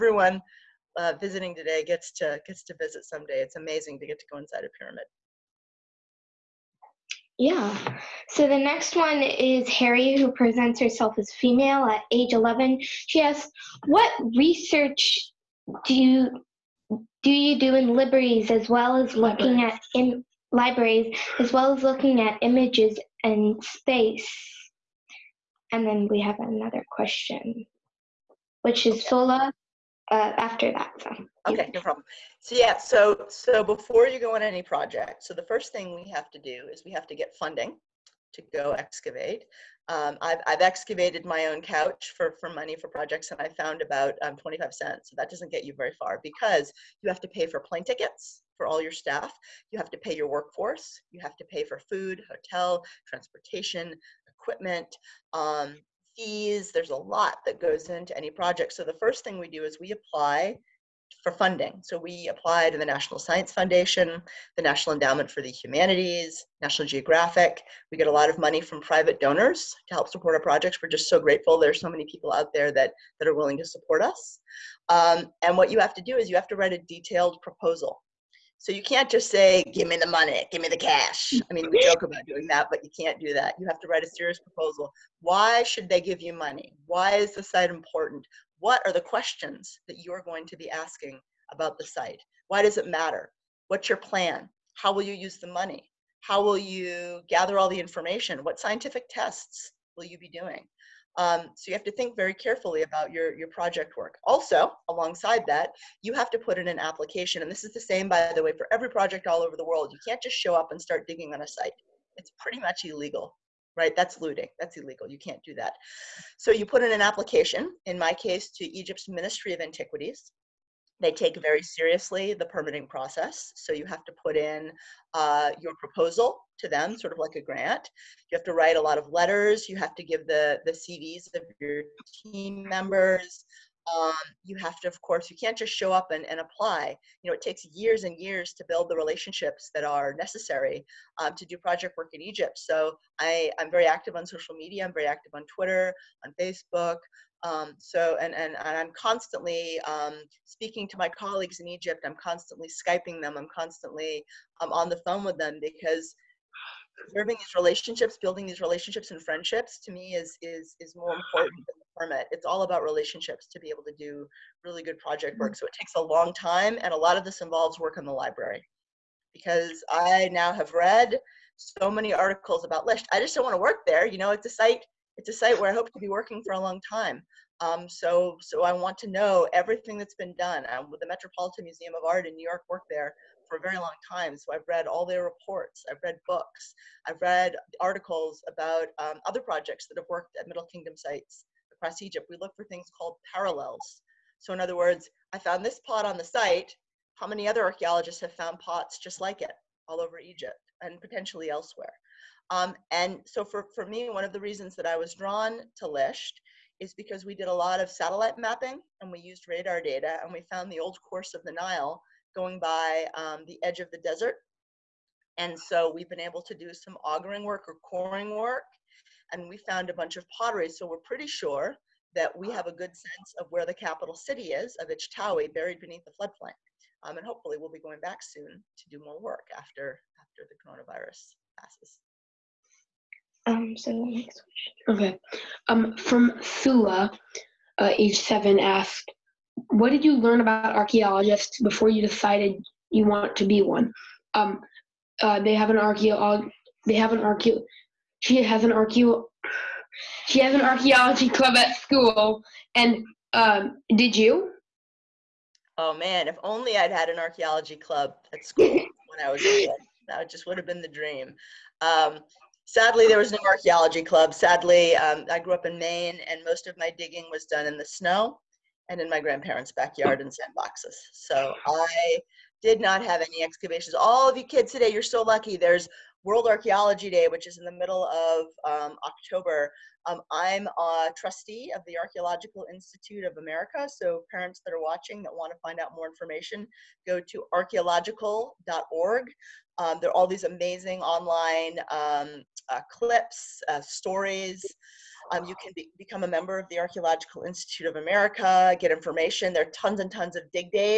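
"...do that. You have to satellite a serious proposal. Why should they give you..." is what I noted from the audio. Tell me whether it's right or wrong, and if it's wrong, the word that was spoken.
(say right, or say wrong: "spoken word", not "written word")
wrong: "write", not "satellite".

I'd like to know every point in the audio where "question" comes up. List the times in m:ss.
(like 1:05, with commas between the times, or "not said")
0:26, 1:29, 3:54.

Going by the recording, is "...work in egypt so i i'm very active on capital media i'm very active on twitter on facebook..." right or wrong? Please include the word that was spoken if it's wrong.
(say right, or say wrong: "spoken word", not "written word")
wrong: "social", not "capital".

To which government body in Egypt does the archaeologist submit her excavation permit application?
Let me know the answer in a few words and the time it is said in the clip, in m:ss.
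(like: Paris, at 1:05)
Ministry of Antiquities, at 1:59.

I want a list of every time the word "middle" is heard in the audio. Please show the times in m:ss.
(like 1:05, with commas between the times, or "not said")
3:10, 4:37.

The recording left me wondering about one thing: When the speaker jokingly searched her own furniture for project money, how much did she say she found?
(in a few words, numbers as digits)
25 cents.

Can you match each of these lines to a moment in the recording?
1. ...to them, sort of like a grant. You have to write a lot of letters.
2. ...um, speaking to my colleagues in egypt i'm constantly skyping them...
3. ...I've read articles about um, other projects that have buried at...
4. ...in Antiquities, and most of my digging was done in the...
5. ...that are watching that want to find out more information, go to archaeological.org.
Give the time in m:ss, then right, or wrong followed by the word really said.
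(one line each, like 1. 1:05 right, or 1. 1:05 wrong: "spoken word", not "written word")
1. 2:06 right
2. 2:29 right
3. 3:07 wrong: "worked", not "buried"
4. 4:25 wrong: "Maine", not "Antiquities"
5. 4:44 right.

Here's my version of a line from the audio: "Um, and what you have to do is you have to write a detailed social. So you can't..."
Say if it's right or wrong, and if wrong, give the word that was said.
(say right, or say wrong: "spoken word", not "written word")
wrong: "proposal", not "social".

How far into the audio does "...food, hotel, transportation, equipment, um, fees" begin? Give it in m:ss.
0:51.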